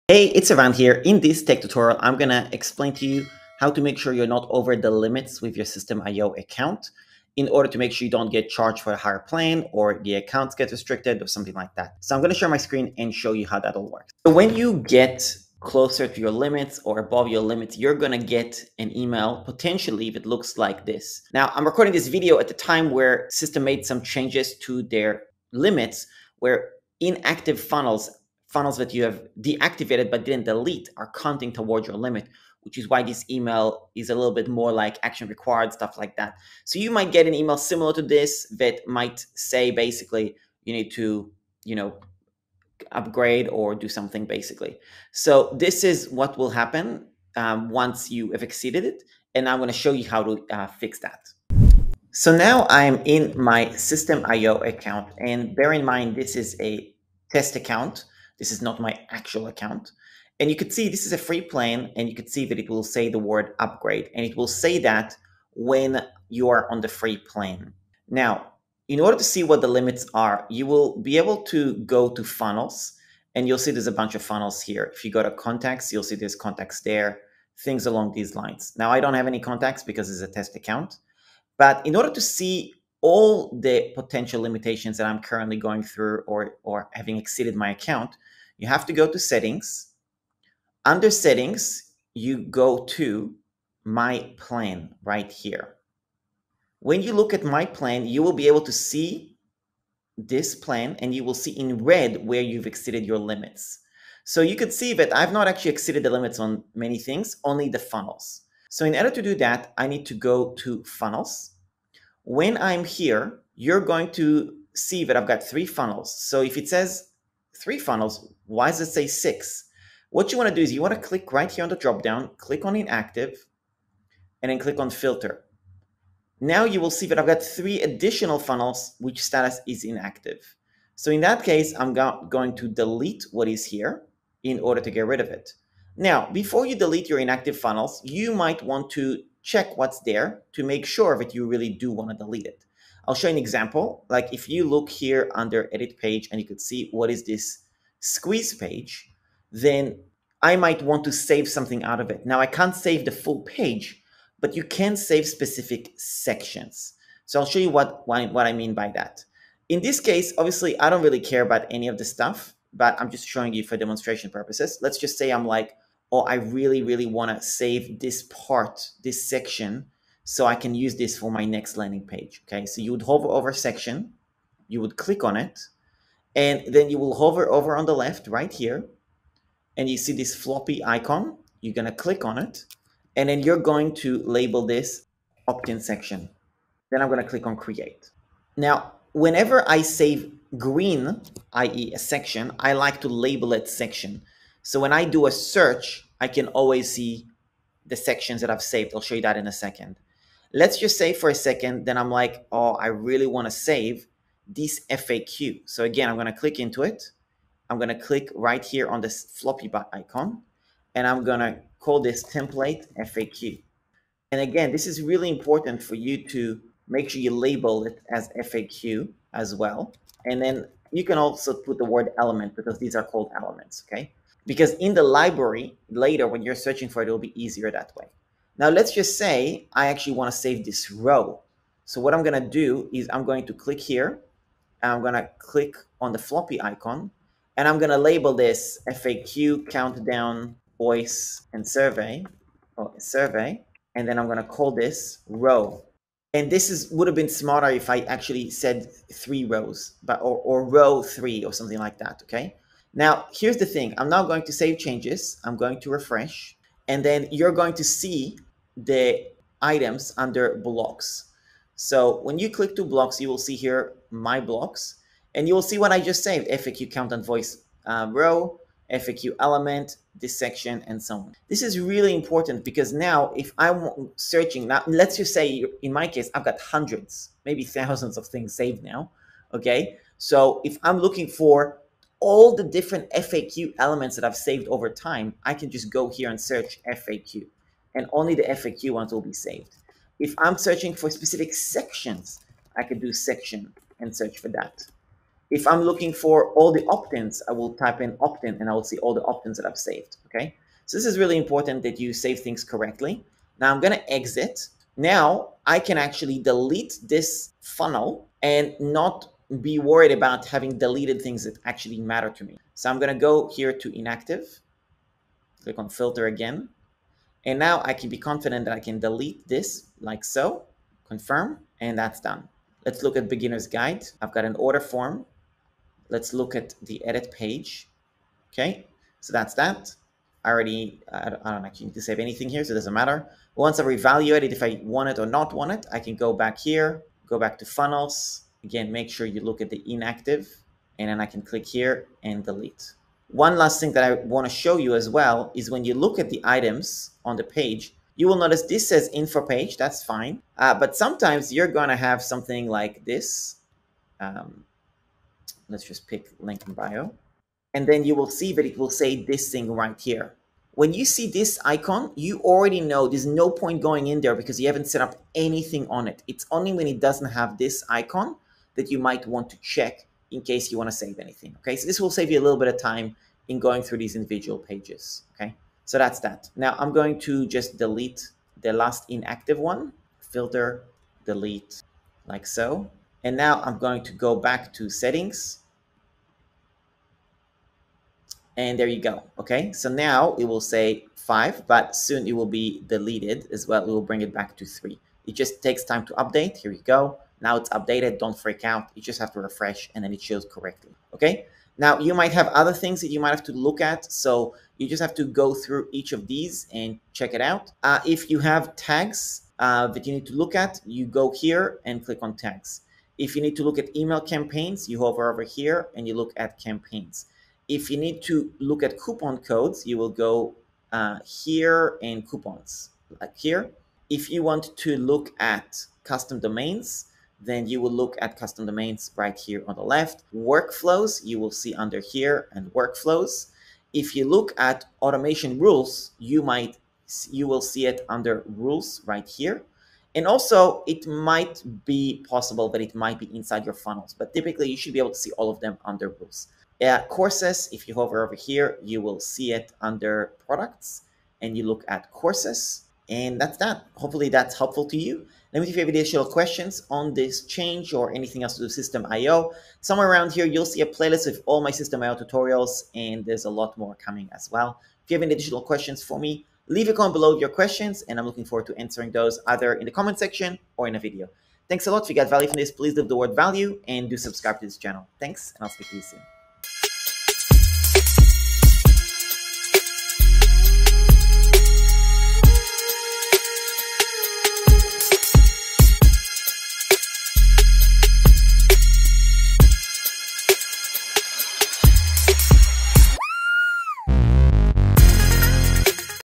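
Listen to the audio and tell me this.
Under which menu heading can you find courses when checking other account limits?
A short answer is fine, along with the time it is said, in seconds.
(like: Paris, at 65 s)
Products, at 450 s.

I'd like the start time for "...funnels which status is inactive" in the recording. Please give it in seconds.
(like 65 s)
128 s.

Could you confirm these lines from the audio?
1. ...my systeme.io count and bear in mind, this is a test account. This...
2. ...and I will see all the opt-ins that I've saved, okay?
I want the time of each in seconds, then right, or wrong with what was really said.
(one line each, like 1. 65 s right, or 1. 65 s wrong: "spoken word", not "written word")
1. 53 s wrong: "account", not "count"
2. 298 s right.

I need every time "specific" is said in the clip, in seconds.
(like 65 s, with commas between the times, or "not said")
155 s, 291 s.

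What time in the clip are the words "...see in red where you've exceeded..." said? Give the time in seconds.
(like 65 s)
101 s.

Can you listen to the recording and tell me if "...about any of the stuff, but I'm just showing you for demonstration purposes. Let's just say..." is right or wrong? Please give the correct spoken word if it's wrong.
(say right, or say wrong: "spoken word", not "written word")
right.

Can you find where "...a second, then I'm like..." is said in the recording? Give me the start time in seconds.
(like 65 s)
201 s.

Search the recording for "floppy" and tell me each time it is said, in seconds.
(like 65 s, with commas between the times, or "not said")
180 s, 209 s, 236 s.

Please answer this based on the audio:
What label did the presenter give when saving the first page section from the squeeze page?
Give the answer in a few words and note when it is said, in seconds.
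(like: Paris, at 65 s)
opt-in section, at 185 s.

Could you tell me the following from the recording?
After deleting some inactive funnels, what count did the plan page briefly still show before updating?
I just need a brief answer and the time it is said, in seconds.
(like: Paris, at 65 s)
5, at 391 s.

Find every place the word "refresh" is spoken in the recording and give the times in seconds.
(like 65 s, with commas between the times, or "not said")
255 s, 399 s.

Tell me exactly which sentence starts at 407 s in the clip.
Uh, if you have tags uh, that you need to look at, you go here and click on tags.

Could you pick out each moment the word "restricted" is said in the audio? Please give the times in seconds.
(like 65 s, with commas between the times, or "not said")
10 s.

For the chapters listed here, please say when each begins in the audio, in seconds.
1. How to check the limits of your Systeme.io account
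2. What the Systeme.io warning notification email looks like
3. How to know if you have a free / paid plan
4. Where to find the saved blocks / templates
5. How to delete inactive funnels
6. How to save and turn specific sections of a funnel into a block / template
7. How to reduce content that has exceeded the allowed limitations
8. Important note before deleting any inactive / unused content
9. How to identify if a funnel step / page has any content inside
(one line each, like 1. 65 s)
1. 81 s
2. 14 s
3. 52 s
4. 256 s
5. 312 s
6. 159 s
7. 109 s
8. 135 s
9. 343 s.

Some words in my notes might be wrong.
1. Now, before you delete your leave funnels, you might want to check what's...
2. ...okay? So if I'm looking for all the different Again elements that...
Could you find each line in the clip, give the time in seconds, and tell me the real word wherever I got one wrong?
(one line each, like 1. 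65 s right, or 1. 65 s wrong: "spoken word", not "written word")
1. 135 s wrong: "inactive", not "leave"
2. 279 s wrong: "FAQ", not "Again".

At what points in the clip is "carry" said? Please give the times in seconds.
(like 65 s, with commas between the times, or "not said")
not said.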